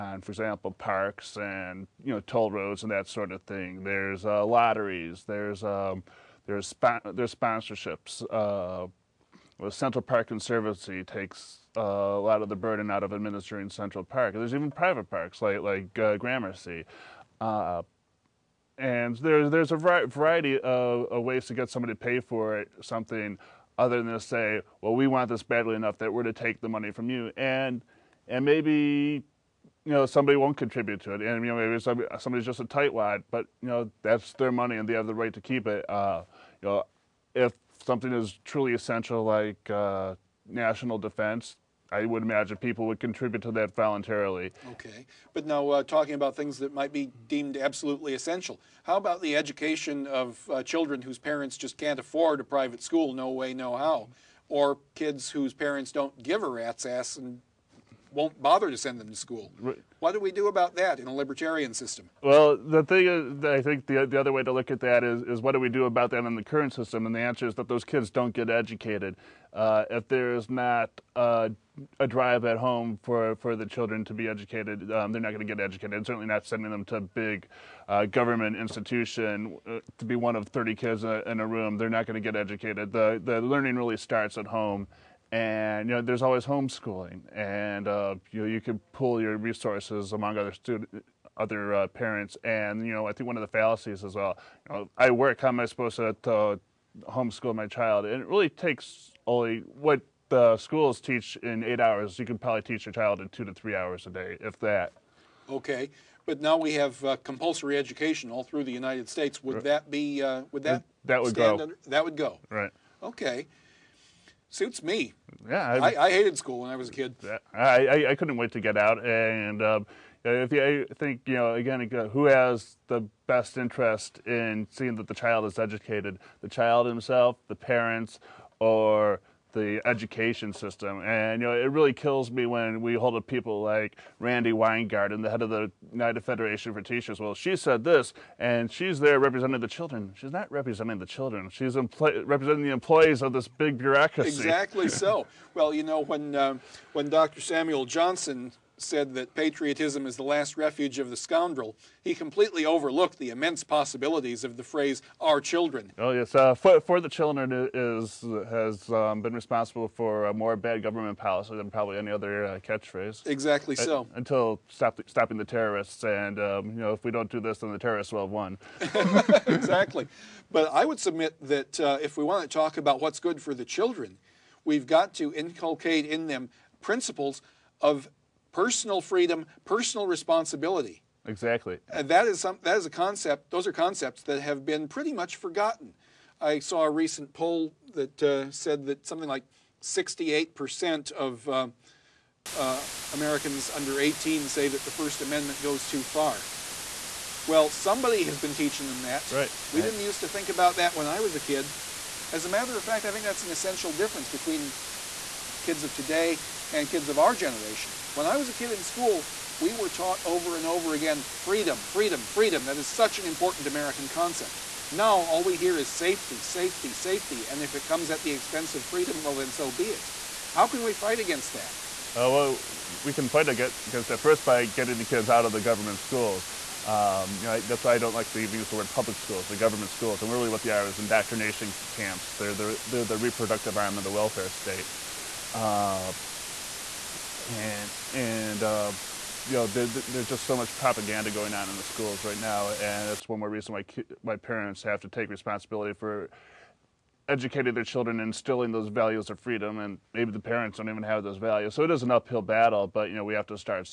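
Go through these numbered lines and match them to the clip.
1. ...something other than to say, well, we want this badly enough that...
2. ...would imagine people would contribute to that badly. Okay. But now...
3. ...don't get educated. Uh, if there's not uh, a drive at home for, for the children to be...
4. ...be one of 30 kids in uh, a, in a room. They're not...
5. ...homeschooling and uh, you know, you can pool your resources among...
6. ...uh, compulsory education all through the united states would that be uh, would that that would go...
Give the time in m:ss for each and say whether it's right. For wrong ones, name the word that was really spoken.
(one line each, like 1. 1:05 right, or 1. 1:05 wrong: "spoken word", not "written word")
1. 0:22 right
2. 0:42 wrong: "voluntarily", not "badly"
3. 1:08 right
4. 1:20 right
5. 1:26 right
6. 1:47 right.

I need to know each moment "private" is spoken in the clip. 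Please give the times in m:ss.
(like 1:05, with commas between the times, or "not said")
0:14, 0:52.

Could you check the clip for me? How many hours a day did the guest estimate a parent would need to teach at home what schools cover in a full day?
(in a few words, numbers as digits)
2 to 3 hours.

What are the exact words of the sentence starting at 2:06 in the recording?
The child himself, the parents, or the education system.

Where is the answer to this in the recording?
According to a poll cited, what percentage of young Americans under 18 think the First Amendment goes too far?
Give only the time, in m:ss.
3:09.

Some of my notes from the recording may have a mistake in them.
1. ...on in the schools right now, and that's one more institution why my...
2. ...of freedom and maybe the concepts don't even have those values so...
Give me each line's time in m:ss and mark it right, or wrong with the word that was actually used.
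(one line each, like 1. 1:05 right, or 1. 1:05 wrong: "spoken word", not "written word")
1. 4:01 wrong: "reason", not "institution"
2. 4:09 wrong: "parents", not "concepts".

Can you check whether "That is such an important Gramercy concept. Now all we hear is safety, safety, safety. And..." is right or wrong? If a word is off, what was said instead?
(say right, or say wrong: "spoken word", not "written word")
wrong: "American", not "Gramercy".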